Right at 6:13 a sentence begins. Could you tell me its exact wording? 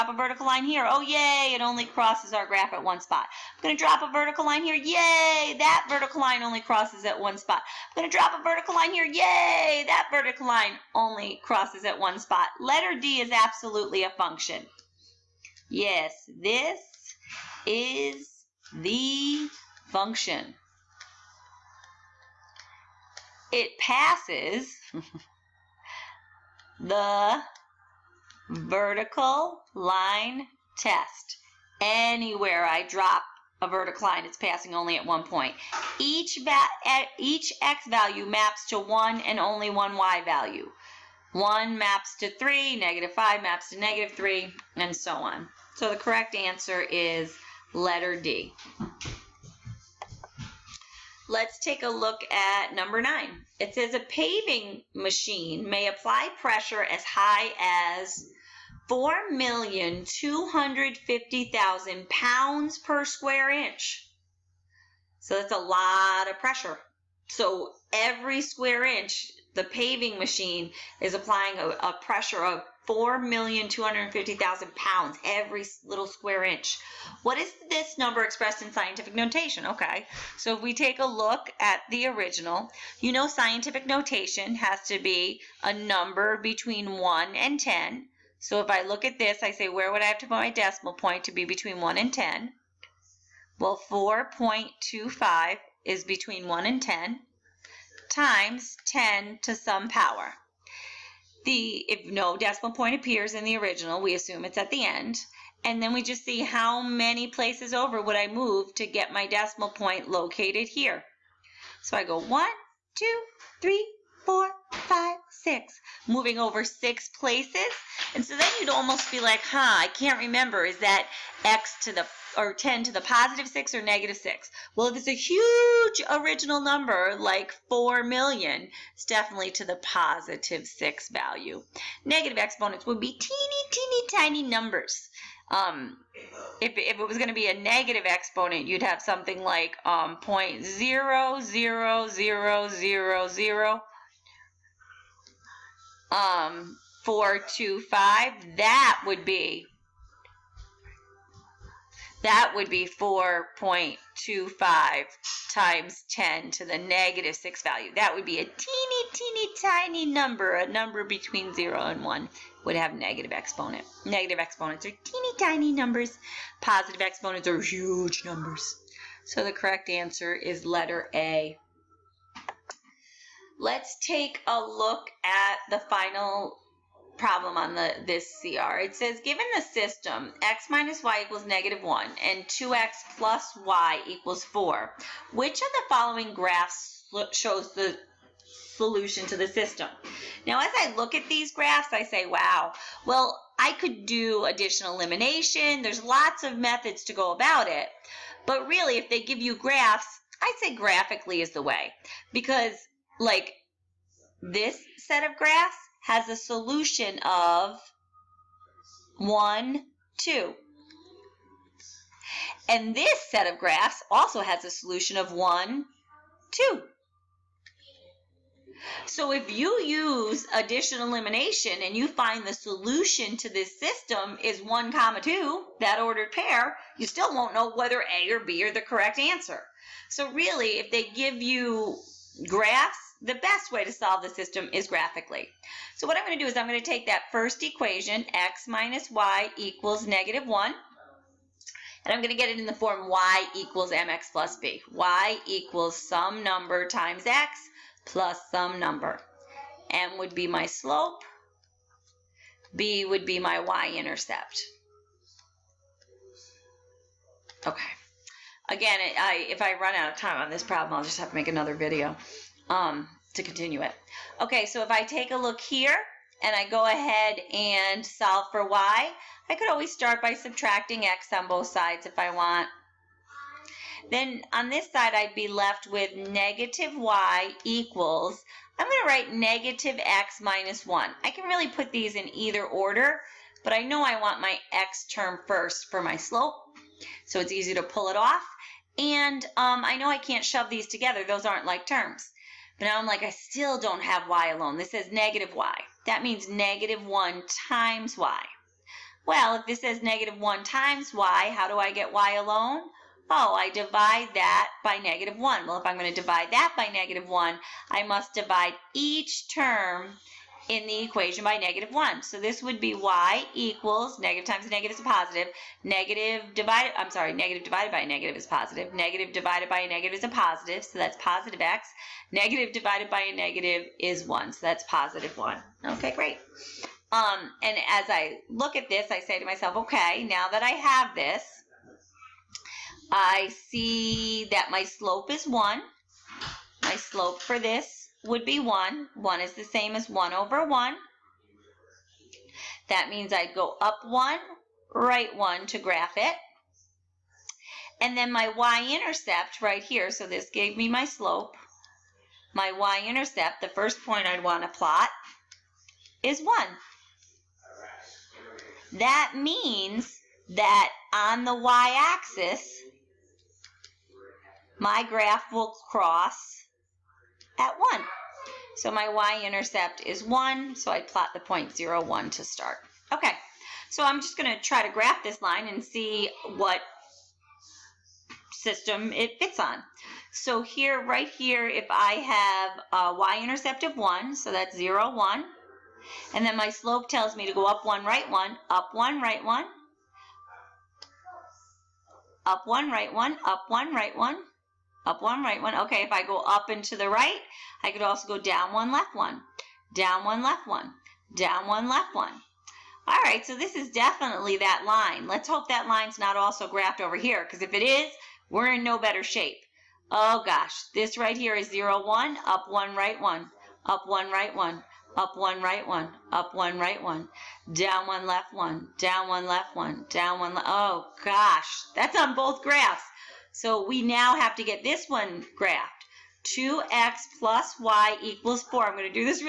Okay, so I'm just going to try to graph this line and see what system it fits on.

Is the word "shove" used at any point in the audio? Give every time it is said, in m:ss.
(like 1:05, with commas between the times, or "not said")
4:50.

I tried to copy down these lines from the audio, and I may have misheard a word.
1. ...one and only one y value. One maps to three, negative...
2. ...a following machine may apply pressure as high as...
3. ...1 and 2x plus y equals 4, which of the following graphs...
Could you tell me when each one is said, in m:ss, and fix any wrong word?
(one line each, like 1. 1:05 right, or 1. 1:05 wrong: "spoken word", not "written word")
1. 0:38 right
2. 0:53 wrong: "paving", not "following"
3. 3:01 right.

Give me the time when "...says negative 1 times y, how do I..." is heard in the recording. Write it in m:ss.
4:59.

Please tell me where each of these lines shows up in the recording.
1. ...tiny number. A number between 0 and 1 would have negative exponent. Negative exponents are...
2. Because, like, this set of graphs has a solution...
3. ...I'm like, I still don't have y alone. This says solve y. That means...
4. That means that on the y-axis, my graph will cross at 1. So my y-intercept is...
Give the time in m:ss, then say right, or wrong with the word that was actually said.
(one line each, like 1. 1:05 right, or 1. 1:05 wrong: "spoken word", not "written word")
1. 2:39 right
2. 3:22 right
3. 4:52 wrong: "negative", not "solve"
4. 5:58 right.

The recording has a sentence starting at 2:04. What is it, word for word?
Well, if it's a huge original number like 4 million, it's definitely to the positive 6 value.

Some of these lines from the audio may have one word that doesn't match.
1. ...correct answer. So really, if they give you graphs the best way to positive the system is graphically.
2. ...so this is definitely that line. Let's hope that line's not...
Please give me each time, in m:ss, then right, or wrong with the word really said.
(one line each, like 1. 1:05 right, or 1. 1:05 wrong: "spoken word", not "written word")
1. 3:48 wrong: "solve", not "positive"
2. 6:43 right.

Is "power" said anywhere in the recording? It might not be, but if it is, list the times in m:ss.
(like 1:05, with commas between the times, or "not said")
1:39.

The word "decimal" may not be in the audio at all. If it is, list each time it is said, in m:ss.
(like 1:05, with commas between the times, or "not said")
1:30, 1:42, 1:49.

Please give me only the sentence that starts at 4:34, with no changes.
Then on this side, I'd be left with negative y equals, I'm going to write negative x minus 1.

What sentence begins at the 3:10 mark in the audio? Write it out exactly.
Now, as I look at these graphs, I say, wow, well, I could do additional elimination.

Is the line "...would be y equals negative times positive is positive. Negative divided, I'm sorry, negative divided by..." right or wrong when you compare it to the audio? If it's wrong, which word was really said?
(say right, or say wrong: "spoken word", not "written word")
wrong: "negative", not "positive".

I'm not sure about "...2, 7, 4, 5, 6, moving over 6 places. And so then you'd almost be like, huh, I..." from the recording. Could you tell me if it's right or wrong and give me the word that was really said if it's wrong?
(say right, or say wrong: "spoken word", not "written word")
wrong: "3", not "7".